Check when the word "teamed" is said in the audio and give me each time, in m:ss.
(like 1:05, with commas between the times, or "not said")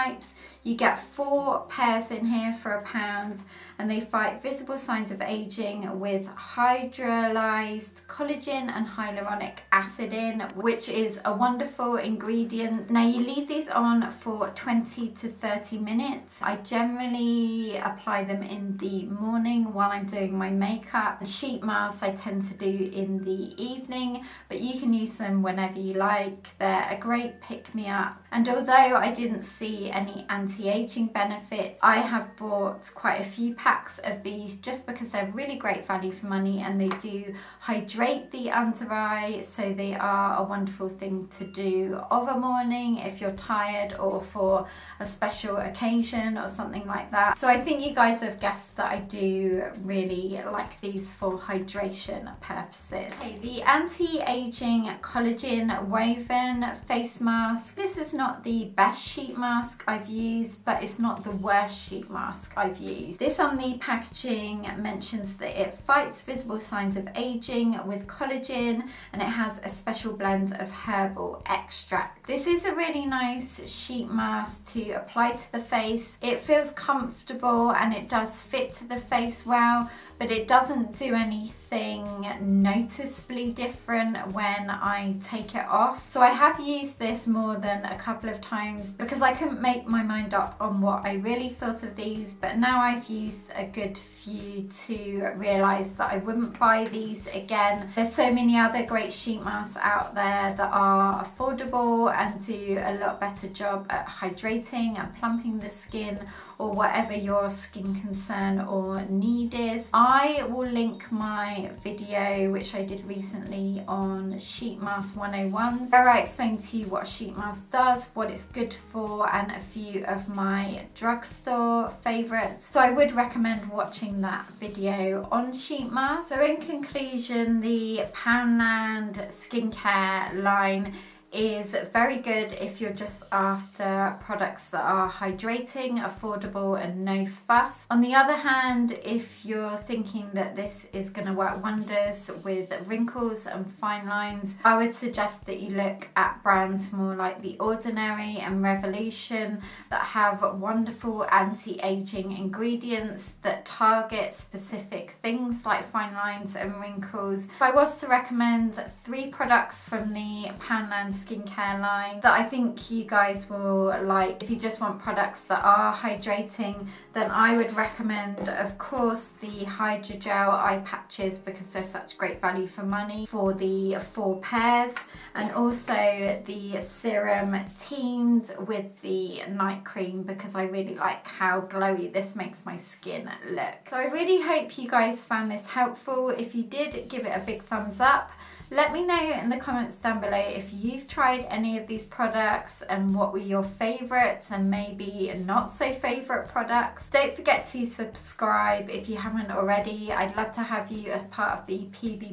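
2:57.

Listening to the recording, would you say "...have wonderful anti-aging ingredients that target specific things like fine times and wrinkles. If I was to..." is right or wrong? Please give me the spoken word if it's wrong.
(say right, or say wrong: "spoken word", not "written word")
wrong: "lines", not "times".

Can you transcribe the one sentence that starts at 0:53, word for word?
Okay, the anti-aging collagen woven face mask.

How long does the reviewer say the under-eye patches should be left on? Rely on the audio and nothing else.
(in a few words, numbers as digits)
20 to 30 minutes.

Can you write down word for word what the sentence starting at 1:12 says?
This is a really nice sheet mask to apply to the face.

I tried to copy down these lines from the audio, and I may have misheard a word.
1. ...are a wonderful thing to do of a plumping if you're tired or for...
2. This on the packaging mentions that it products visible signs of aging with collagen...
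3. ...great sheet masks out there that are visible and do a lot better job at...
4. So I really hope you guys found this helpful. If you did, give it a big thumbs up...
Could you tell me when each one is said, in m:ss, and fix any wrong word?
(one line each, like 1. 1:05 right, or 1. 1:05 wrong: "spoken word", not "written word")
1. 0:39 wrong: "morning", not "plumping"
2. 1:03 wrong: "fights", not "products"
3. 1:38 wrong: "affordable", not "visible"
4. 3:03 right.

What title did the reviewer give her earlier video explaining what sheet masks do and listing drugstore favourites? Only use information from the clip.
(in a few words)
Sheet mask 101.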